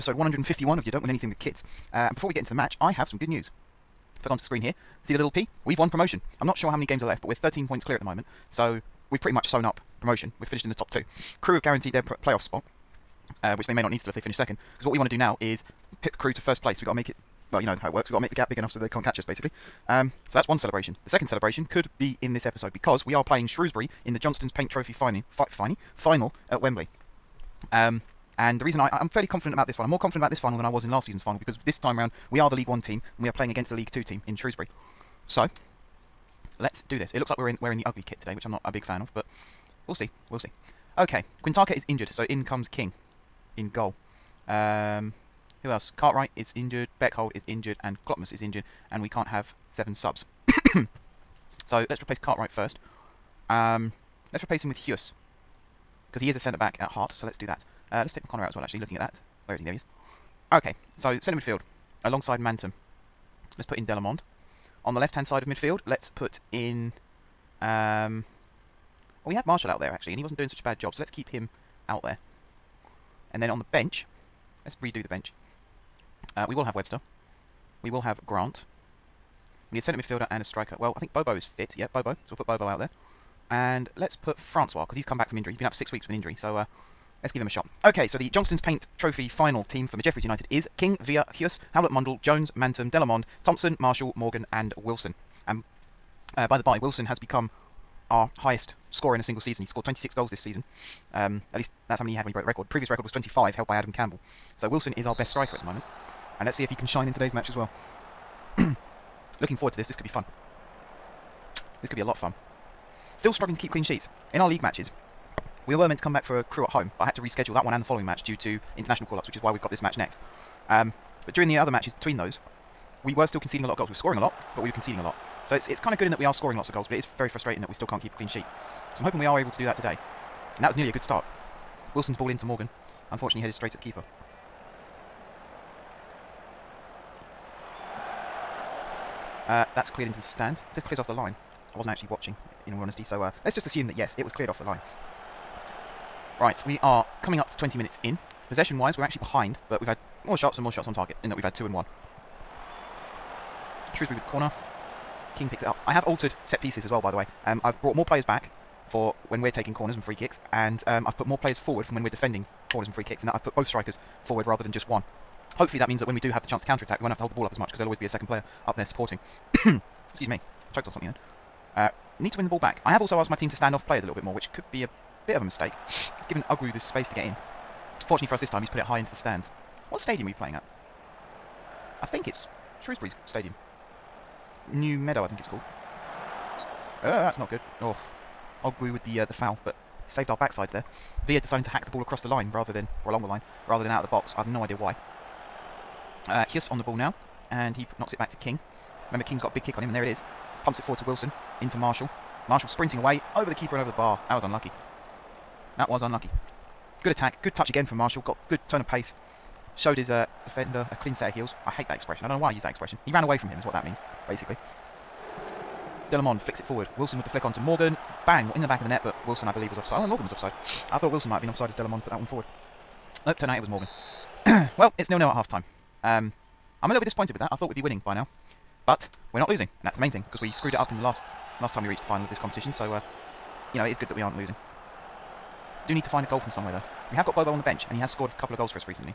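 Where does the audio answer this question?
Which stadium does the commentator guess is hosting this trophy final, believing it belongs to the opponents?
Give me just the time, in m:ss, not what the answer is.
3:04.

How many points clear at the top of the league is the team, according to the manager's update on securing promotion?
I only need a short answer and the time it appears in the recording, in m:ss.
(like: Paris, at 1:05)
13, at 0:07.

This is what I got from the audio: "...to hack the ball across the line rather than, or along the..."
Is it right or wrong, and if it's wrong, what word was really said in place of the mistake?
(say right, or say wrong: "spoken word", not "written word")
right.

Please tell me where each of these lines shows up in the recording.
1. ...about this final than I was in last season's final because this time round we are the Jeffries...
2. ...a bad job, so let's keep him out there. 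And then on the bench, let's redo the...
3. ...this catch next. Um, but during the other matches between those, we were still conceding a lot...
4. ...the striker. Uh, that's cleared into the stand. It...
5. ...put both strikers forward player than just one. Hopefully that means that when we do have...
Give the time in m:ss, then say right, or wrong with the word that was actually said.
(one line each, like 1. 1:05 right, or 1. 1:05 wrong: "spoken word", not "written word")
1. 0:30 wrong: "League", not "Jeffries"
2. 1:10 right
3. 1:59 wrong: "match", not "catch"
4. 2:13 wrong: "keeper", not "striker"
5. 2:43 wrong: "rather", not "player".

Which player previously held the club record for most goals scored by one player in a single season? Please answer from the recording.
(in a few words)
Adam Campbell.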